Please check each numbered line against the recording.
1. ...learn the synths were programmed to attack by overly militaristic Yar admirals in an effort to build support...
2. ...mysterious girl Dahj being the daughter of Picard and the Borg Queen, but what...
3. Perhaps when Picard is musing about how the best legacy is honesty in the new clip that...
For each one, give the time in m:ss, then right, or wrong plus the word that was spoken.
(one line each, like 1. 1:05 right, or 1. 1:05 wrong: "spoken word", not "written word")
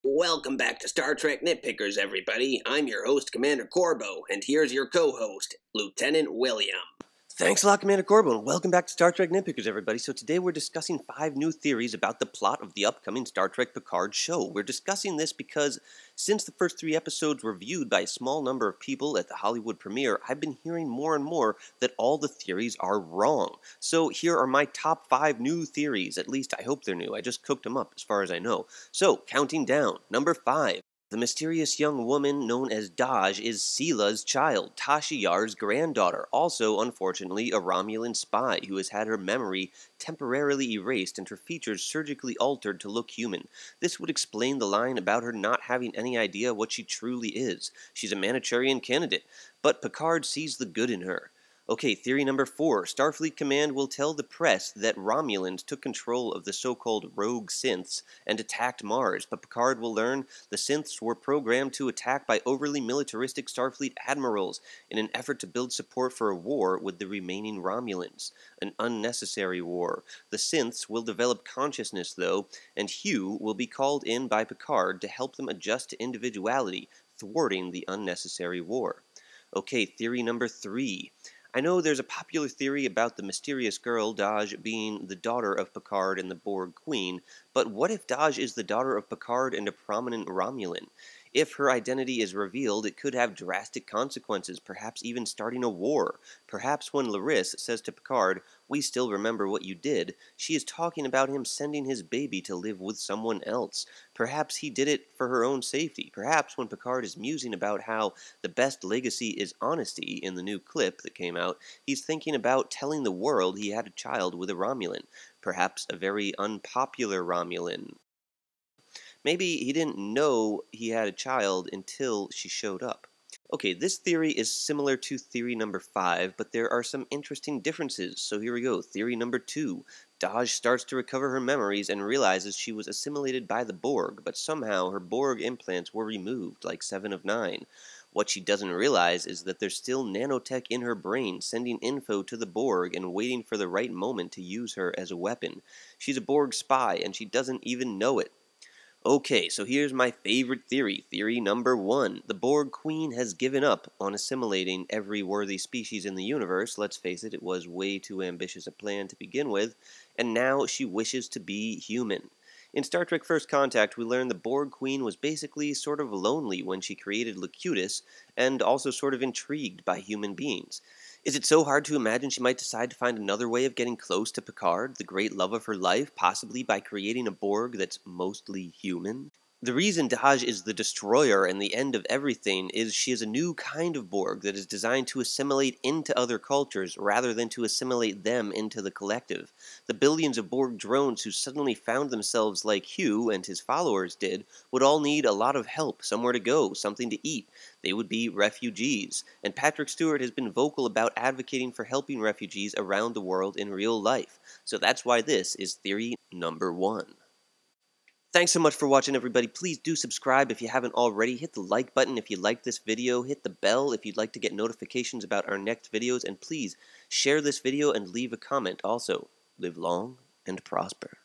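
1. 0:59 wrong: "Starfleet", not "Yar"
2. 1:23 right
3. 1:46 right.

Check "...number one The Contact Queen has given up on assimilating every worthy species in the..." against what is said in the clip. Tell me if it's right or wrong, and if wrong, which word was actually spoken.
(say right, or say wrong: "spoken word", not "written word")
wrong: "Borg", not "Contact".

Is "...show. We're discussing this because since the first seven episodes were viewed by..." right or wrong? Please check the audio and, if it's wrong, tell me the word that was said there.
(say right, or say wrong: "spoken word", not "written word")
wrong: "three", not "seven".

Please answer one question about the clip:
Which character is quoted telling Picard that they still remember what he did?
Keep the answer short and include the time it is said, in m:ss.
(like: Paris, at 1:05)
Laris, at 1:37.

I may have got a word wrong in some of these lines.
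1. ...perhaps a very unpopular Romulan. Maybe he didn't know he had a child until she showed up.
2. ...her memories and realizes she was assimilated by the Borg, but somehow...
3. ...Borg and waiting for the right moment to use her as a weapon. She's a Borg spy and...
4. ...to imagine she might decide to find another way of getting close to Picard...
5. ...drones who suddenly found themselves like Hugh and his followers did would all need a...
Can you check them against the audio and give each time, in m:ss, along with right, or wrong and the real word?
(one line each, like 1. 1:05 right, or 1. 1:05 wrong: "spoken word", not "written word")
1. 1:55 right
2. 2:11 right
3. 2:22 right
4. 2:51 right
5. 3:10 right.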